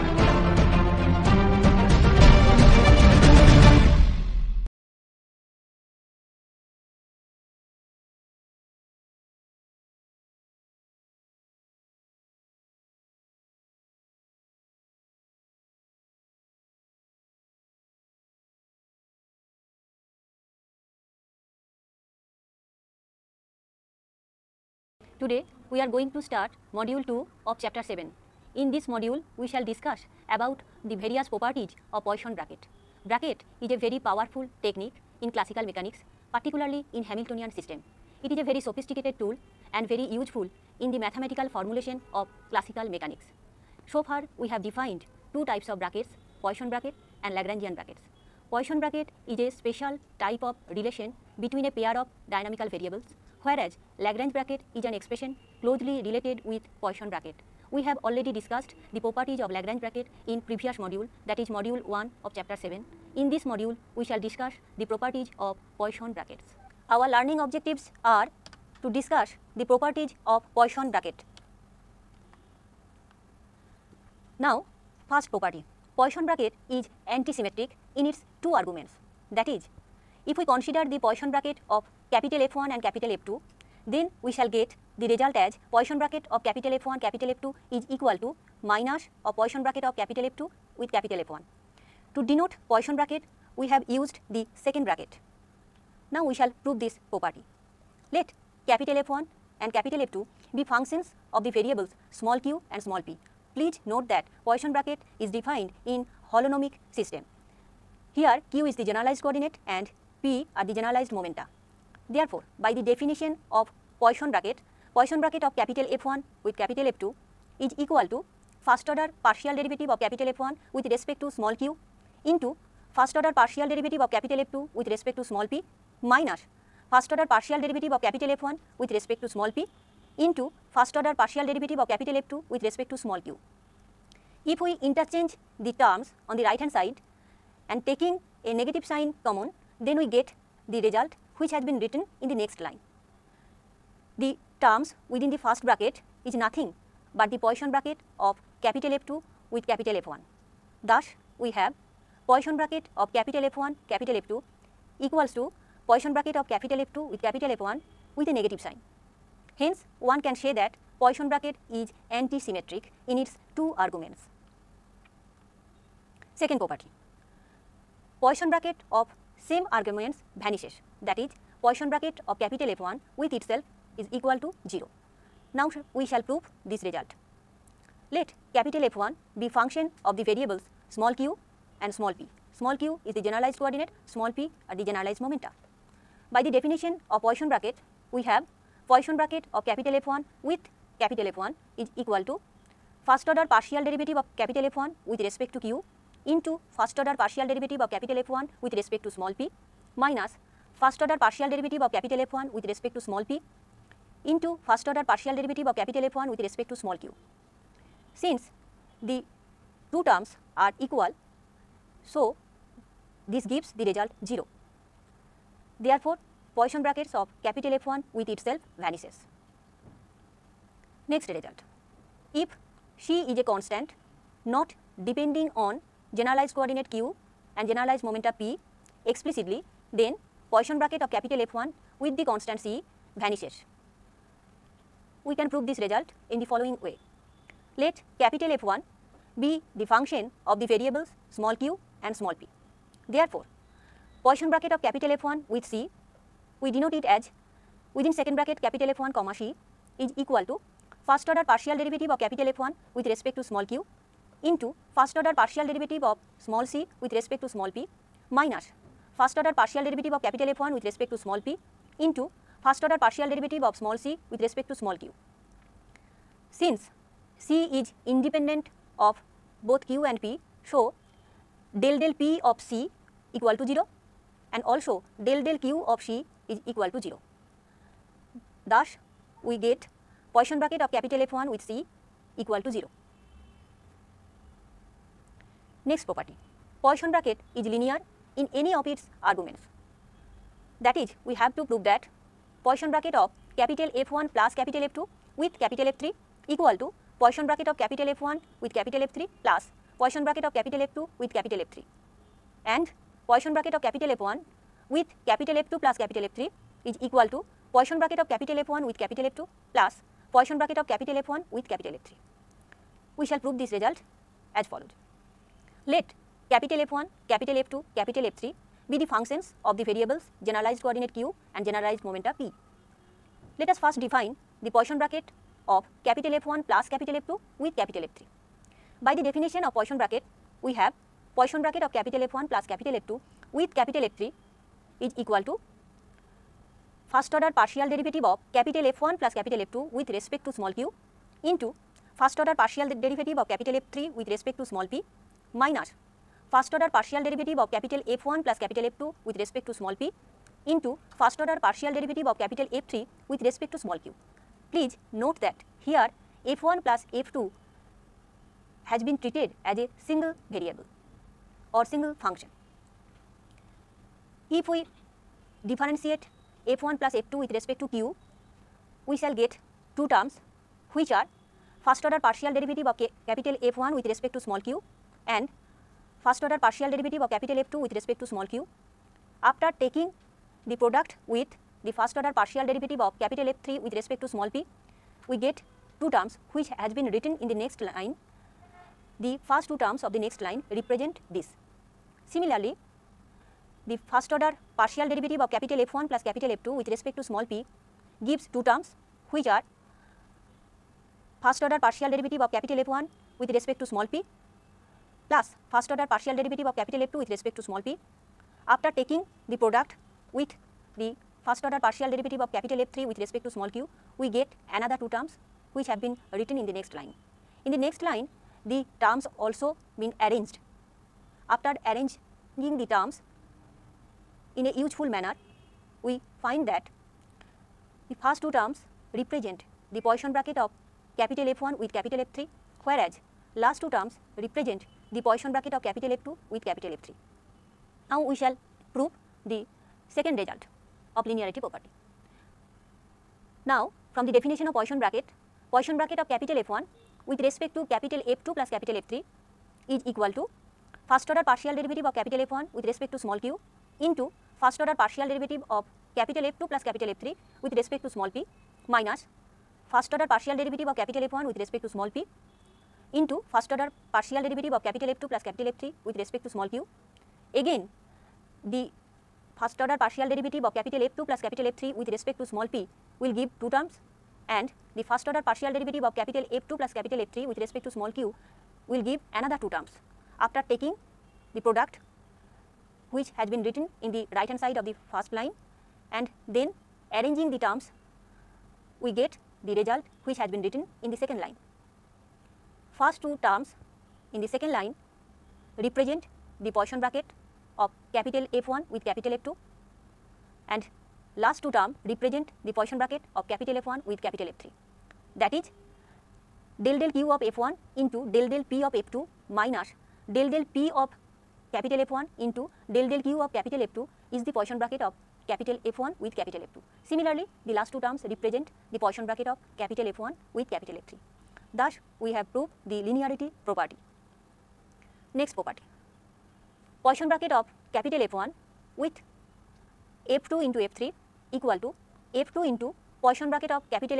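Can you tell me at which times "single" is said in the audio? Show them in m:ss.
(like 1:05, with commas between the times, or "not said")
6:00.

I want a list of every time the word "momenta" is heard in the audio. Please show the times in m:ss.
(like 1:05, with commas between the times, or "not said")
1:51, 3:05, 3:48, 5:22.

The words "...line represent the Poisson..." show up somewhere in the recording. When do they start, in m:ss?
8:14.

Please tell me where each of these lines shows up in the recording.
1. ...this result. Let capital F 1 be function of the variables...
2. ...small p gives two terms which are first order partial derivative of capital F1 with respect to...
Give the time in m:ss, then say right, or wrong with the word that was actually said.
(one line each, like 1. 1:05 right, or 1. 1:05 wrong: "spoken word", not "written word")
1. 2:56 right
2. 6:37 right.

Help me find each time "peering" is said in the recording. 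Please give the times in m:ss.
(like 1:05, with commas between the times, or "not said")
not said.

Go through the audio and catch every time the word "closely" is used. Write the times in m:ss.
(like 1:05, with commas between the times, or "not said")
0:55.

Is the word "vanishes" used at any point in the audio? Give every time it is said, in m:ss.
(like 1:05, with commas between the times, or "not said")
2:50, 3:38, 3:53.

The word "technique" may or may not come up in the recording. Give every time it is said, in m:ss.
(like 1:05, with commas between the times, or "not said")
0:34.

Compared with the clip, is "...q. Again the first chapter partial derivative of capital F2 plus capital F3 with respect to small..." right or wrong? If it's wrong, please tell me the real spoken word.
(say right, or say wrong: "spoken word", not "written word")
wrong: "order", not "chapter".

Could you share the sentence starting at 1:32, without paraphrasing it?
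To denote Poisson bracket, we have used the second bracket.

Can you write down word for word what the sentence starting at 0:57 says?
We have already discussed the properties of Lagrange bracket in previous module that is module 1 of chapter 7.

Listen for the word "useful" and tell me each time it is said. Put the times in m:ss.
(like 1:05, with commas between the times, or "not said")
0:40, 7:04.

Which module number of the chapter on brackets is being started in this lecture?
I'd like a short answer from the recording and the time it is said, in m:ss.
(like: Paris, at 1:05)
Module 2, at 0:26.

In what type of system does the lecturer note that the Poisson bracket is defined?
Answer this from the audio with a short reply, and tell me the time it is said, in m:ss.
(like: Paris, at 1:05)
Holonomic system, at 1:46.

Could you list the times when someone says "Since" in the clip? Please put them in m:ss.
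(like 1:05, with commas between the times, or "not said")
3:28, 4:26.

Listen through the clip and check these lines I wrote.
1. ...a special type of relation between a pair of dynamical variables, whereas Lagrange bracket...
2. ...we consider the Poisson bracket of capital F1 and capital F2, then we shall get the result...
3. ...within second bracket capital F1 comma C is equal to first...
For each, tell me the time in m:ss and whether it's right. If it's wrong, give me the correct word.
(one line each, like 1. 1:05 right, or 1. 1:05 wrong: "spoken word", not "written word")
1. 0:49 right
2. 1:20 right
3. 4:07 right.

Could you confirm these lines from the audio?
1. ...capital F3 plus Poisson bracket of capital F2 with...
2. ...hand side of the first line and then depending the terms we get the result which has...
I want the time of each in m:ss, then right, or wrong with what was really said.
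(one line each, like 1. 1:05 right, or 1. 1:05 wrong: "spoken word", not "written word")
1. 4:58 right
2. 8:04 wrong: "arranging", not "depending".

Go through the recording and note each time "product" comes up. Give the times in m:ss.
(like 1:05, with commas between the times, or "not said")
6:20, 6:49, 8:01.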